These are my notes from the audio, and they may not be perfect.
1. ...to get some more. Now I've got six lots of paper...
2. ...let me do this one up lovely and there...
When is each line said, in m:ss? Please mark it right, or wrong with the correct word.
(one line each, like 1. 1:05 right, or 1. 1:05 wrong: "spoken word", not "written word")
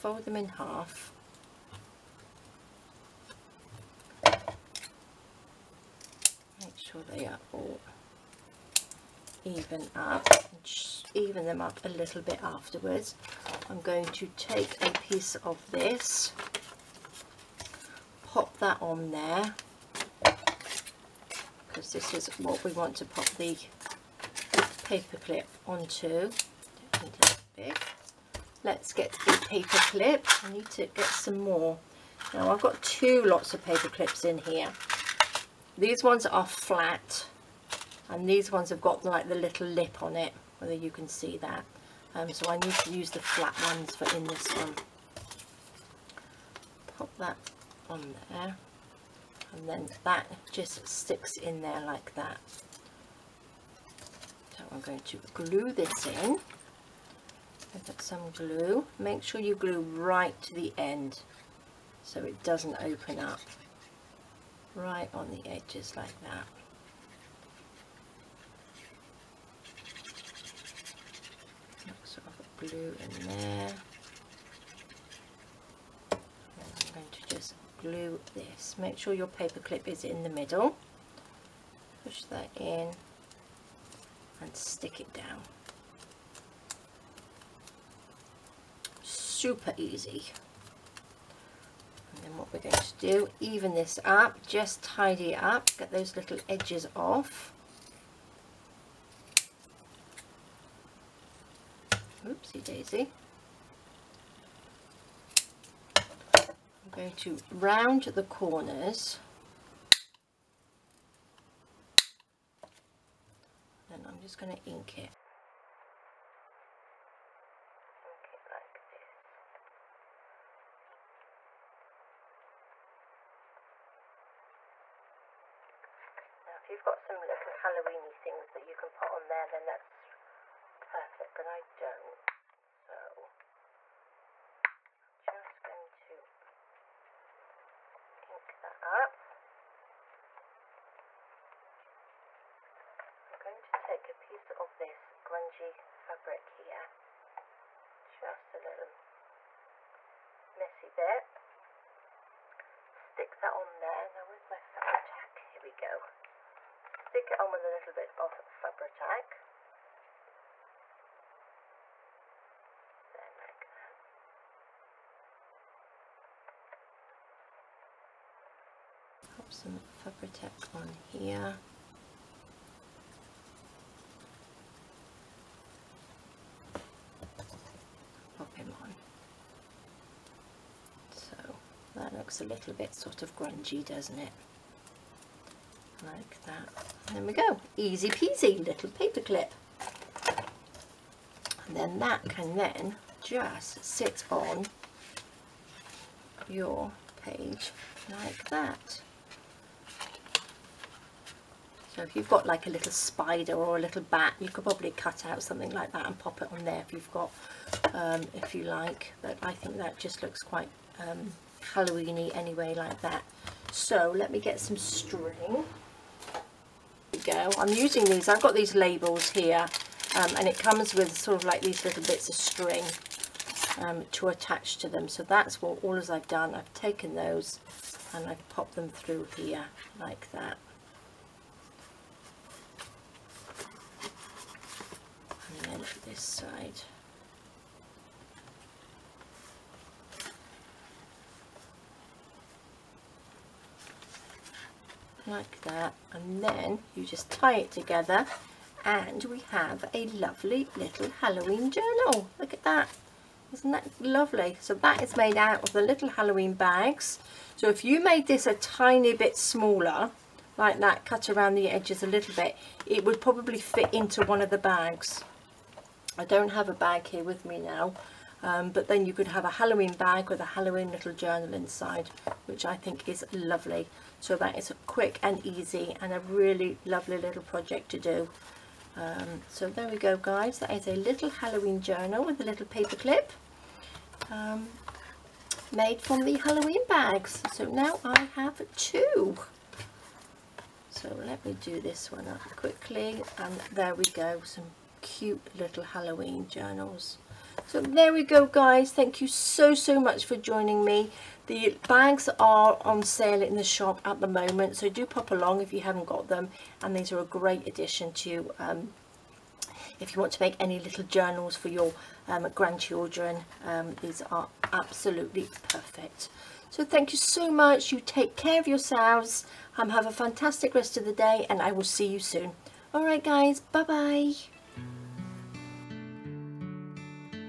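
1. 0:30 wrong: "two", not "six"
2. 4:51 wrong: "quickly", not "lovely".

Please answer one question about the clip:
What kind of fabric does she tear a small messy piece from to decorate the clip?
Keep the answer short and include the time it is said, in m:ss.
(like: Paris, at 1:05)
Grungy fabric, at 2:25.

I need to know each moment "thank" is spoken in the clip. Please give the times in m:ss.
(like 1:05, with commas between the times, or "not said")
4:58, 5:16.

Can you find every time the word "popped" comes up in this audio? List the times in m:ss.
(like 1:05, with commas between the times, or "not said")
3:48.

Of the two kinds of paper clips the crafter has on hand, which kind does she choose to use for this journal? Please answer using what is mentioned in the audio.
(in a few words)
The flat ones.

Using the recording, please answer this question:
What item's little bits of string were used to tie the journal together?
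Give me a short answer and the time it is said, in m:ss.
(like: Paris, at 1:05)
Labels, at 3:38.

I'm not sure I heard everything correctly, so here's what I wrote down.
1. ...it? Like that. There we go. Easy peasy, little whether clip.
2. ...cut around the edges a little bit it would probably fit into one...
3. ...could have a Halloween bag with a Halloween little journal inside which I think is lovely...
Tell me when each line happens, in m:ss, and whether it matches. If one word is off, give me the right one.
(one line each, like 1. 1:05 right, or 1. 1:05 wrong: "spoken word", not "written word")
1. 3:04 wrong: "paper", not "whether"
2. 4:21 right
3. 4:29 right.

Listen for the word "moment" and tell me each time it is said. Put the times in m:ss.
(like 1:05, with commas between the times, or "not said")
5:04.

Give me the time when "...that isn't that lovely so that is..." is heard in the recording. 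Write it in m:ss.
4:12.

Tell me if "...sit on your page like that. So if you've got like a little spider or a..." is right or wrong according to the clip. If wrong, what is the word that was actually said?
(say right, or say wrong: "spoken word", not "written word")
right.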